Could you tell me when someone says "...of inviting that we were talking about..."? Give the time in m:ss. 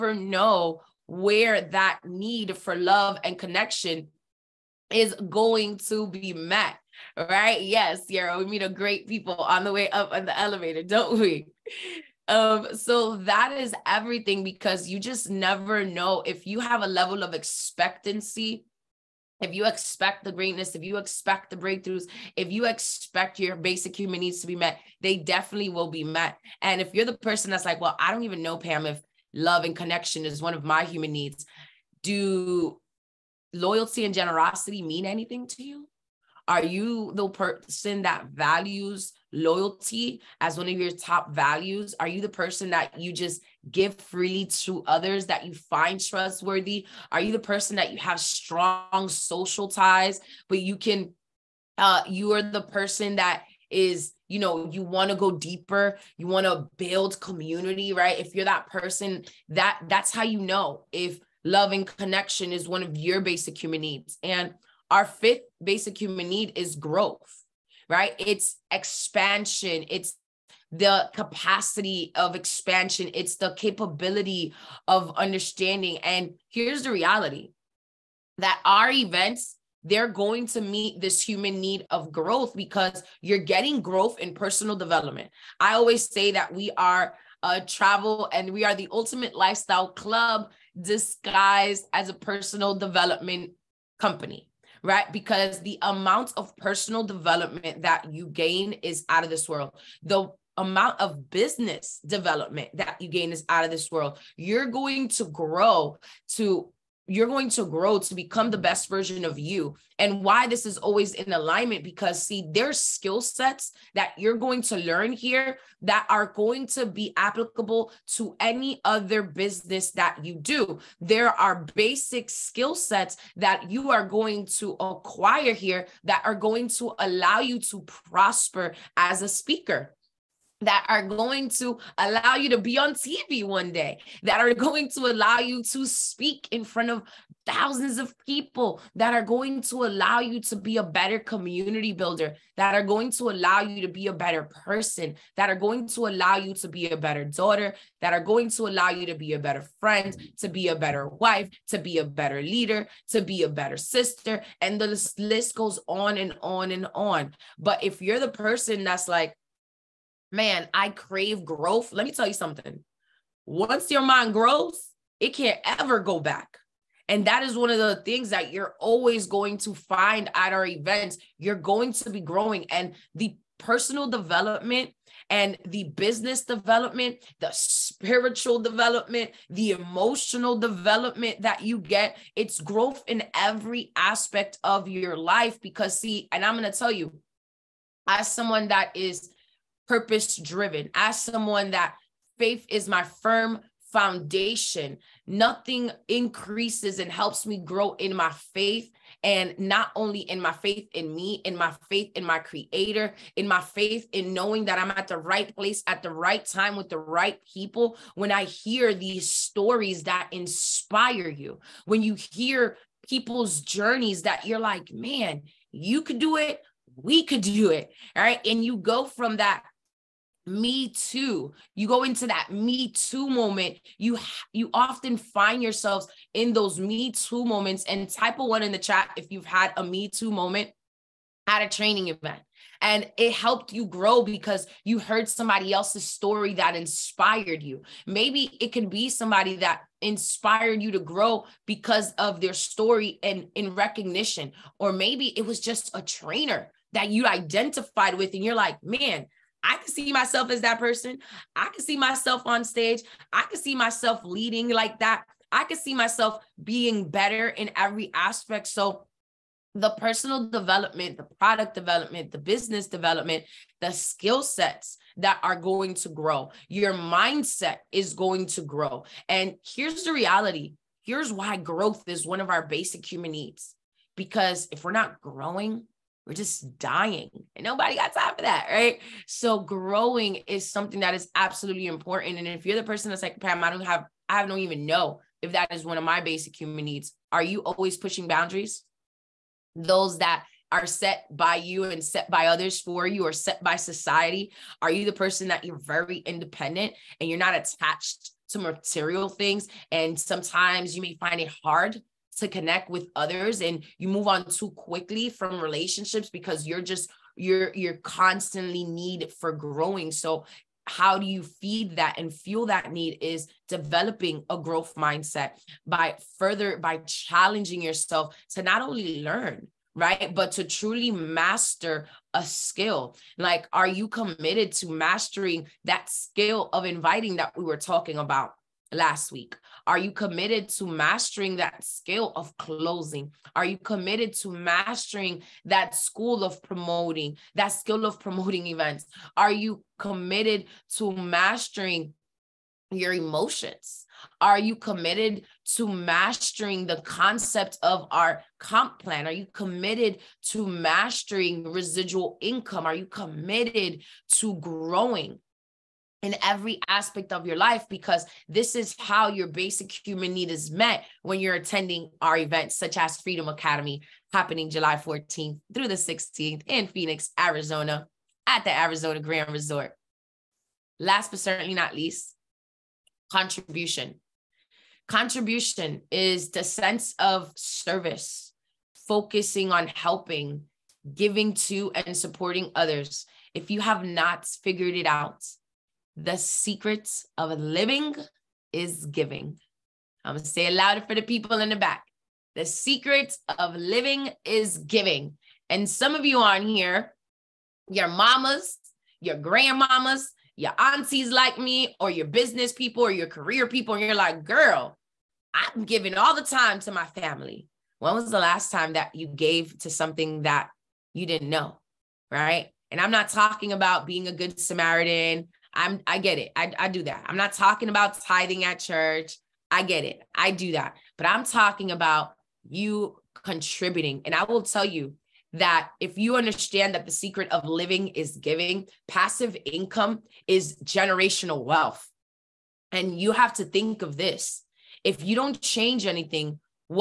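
5:26.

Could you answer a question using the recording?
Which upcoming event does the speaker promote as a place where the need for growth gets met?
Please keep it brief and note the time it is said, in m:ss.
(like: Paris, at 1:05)
Freedom Academy, at 6:03.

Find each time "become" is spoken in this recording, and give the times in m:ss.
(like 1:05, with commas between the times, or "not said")
1:48.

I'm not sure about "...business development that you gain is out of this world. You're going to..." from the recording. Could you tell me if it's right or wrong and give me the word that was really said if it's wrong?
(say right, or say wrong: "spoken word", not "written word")
right.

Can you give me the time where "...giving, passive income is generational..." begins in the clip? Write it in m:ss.
7:08.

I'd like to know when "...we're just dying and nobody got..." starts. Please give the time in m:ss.
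4:36.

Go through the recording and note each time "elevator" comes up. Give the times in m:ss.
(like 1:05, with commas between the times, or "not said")
0:10.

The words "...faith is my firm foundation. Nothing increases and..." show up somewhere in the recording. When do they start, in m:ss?
3:12.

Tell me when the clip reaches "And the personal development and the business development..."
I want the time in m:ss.
2:52.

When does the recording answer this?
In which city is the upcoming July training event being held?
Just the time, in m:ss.
6:06.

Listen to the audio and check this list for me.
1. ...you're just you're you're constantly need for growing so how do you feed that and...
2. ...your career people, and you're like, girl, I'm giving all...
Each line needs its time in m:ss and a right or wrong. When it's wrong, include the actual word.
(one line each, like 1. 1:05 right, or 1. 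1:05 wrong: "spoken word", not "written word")
1. 5:06 right
2. 6:43 right.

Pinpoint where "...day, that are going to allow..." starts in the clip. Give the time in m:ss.
2:13.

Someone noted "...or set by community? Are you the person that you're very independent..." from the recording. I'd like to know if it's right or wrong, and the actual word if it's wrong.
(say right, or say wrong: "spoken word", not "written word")
wrong: "society", not "community".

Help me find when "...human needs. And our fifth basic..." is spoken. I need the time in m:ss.
1:03.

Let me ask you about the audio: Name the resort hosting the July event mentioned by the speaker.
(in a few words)
Arizona Grand Resort.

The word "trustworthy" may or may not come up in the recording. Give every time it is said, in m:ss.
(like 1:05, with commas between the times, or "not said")
0:46.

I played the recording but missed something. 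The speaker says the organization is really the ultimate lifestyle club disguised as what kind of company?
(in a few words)
A personal development company.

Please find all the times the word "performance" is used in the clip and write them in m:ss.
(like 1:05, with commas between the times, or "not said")
not said.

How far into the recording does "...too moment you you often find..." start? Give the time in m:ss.
3:42.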